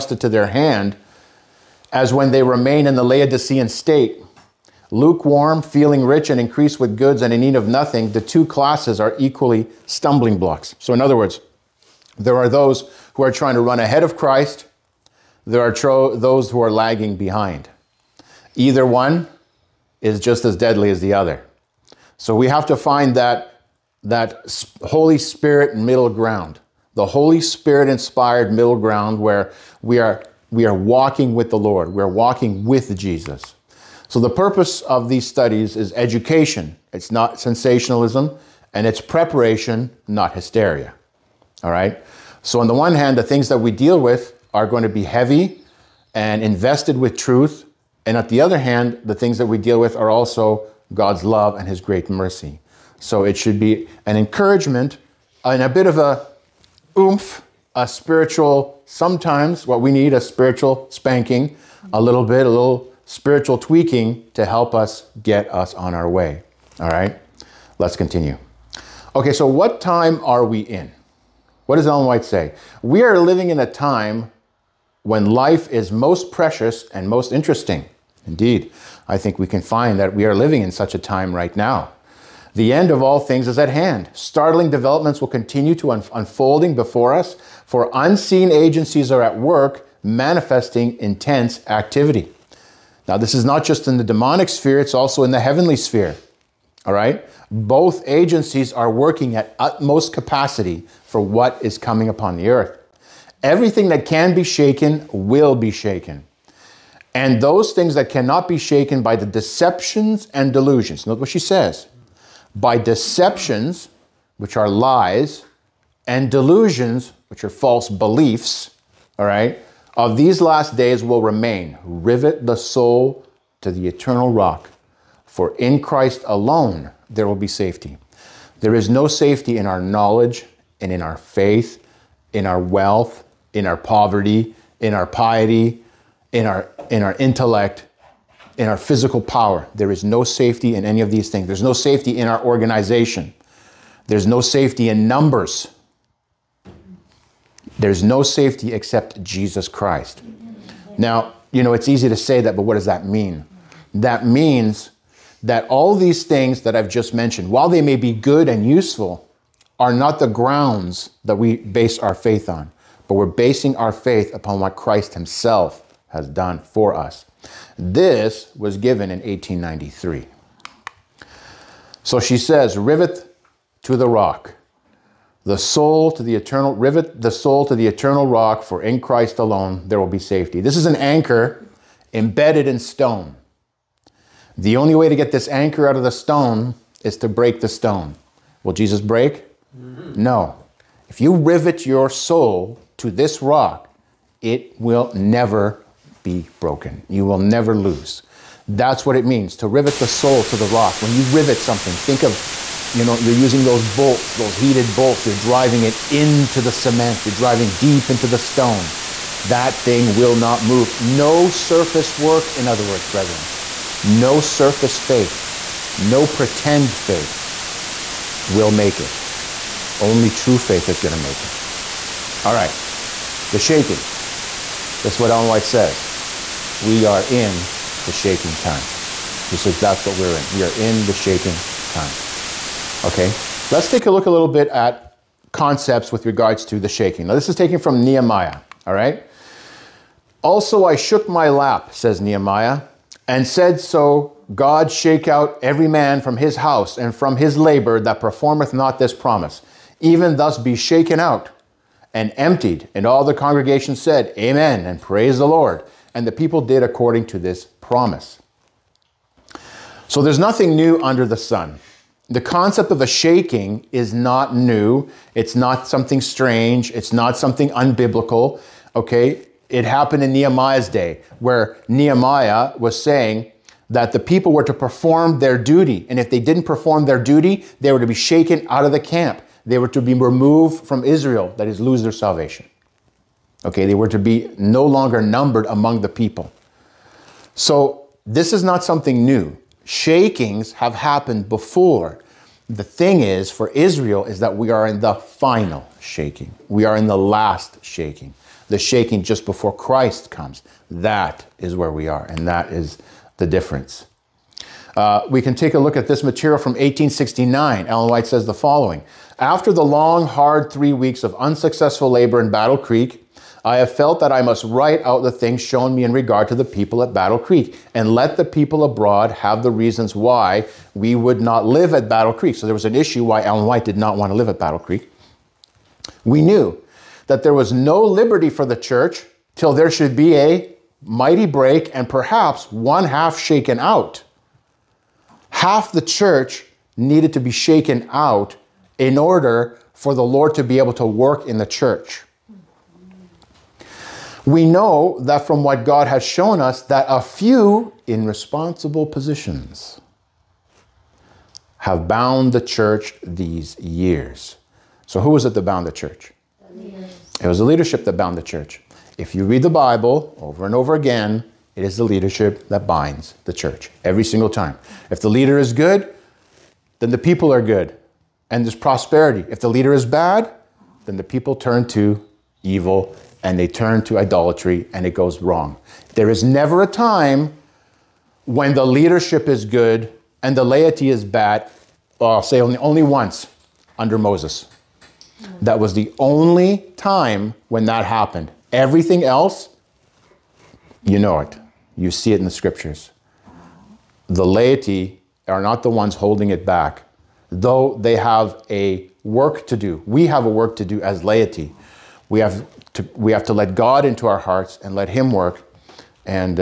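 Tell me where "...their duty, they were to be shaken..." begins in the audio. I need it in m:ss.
4:37.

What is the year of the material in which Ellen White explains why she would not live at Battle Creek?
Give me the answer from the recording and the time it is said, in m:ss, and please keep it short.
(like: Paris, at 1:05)
1869, at 5:06.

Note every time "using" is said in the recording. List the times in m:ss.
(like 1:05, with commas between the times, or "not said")
3:23.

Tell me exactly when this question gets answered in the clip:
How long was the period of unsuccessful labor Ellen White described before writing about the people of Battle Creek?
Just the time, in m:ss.
5:10.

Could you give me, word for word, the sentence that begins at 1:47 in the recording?
And those things that cannot be shaken by the deceptions and delusions.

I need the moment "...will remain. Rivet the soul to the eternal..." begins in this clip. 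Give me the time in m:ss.
2:01.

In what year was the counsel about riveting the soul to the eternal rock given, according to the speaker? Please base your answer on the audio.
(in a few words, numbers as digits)
1893.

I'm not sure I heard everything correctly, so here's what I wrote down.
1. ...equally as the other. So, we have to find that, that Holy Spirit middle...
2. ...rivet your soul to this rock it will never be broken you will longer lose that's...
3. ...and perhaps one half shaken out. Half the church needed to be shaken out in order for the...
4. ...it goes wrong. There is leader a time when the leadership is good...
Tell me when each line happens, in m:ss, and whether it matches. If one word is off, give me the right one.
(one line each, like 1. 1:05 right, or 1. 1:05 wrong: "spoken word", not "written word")
1. 0:20 wrong: "deadly", not "equally"
2. 3:11 wrong: "never", not "longer"
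3. 5:31 right
4. 6:15 wrong: "never", not "leader".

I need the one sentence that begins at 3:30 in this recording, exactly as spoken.
No surface work, in other words, brethren.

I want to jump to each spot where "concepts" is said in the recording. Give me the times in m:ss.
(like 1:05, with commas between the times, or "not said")
3:55, 4:22.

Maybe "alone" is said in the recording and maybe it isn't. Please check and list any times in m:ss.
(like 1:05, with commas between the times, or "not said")
2:06, 2:59.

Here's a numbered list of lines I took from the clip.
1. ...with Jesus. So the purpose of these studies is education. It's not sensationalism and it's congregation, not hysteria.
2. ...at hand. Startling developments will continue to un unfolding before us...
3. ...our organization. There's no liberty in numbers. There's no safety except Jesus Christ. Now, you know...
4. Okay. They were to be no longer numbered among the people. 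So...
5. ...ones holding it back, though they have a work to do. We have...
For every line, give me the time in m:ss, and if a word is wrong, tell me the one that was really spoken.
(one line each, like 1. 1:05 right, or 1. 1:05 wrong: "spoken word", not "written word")
1. 0:32 wrong: "preparation", not "congregation"
2. 1:23 right
3. 2:22 wrong: "safety", not "liberty"
4. 4:43 right
5. 6:35 right.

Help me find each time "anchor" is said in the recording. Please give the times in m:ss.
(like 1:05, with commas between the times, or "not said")
3:00, 3:05.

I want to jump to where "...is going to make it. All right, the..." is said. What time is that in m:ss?
3:40.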